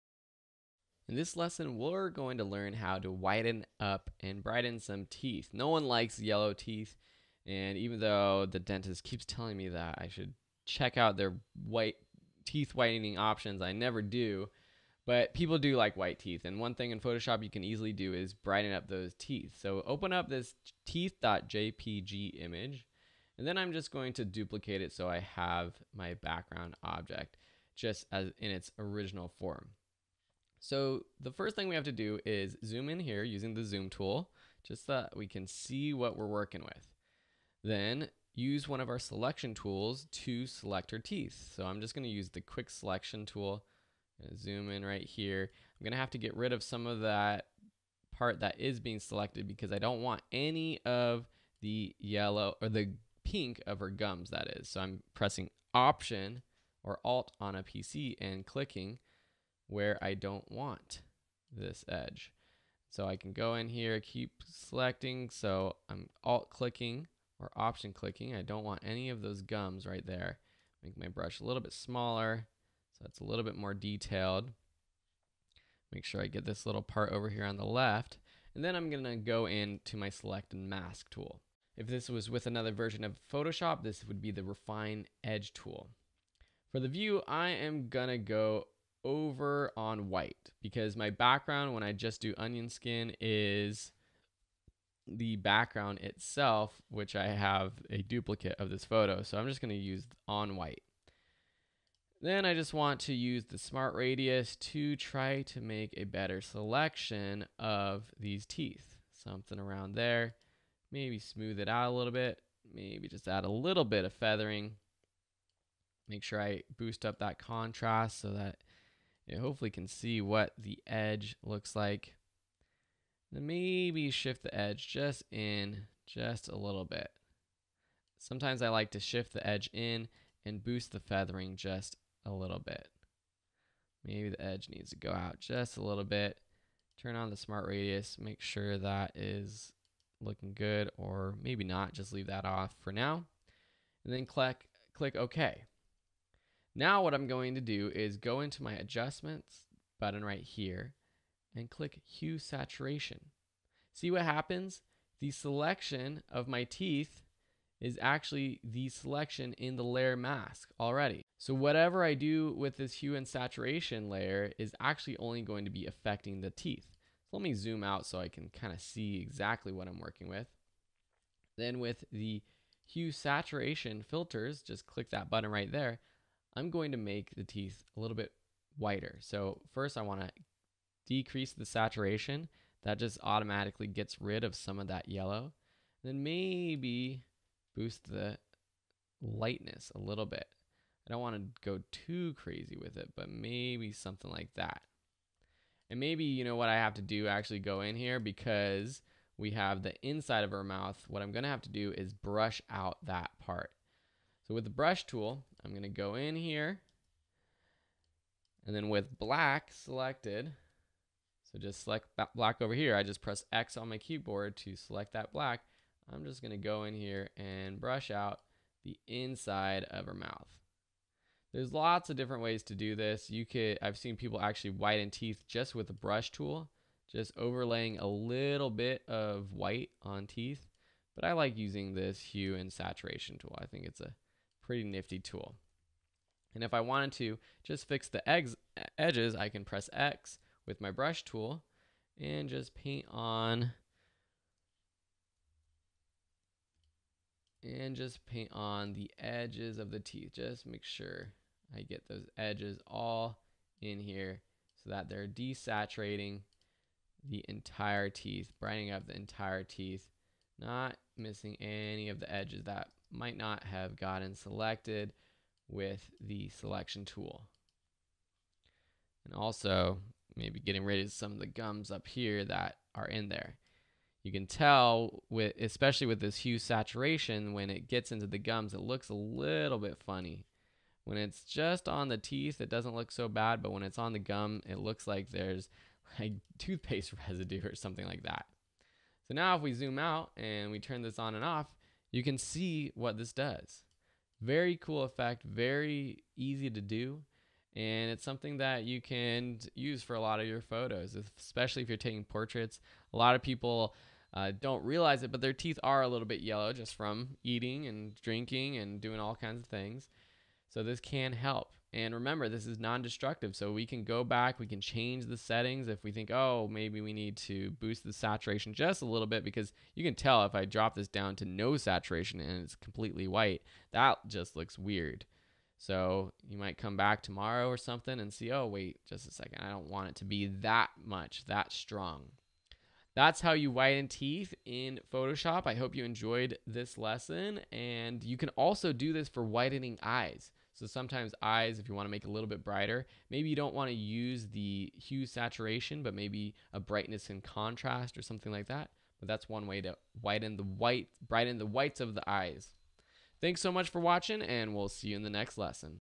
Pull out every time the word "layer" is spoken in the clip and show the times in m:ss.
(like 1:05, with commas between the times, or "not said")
2:39, 2:44.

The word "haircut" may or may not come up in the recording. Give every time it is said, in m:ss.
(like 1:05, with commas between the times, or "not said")
not said.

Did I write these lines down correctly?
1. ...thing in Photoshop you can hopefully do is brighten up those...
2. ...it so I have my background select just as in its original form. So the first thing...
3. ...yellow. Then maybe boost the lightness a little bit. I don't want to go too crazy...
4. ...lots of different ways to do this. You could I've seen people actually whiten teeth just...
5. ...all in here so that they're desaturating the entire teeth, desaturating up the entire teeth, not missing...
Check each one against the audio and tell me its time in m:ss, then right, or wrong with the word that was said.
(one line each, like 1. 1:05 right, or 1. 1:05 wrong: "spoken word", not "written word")
1. 0:16 wrong: "easily", not "hopefully"
2. 0:24 wrong: "object", not "select"
3. 3:05 right
4. 3:41 right
5. 4:12 wrong: "brightening", not "desaturating".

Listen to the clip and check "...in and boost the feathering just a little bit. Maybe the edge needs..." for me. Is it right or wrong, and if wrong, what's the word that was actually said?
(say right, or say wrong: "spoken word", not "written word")
right.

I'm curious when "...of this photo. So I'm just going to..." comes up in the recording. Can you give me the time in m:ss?
1:38.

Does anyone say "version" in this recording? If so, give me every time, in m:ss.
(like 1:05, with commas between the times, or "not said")
1:22.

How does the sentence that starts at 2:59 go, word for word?
So first I want to decrease the saturation.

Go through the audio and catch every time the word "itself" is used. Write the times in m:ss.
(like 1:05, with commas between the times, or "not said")
1:35.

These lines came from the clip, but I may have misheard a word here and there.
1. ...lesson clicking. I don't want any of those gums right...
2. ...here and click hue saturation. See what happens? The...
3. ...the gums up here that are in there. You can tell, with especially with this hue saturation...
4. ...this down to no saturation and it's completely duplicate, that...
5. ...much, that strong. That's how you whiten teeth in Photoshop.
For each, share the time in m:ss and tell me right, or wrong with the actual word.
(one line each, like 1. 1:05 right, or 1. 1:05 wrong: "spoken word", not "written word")
1. 1:07 wrong: "option", not "lesson"
2. 2:30 right
3. 4:31 right
4. 5:20 wrong: "white", not "duplicate"
5. 5:31 right.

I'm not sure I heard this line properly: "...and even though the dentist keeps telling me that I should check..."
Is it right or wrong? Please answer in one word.
right.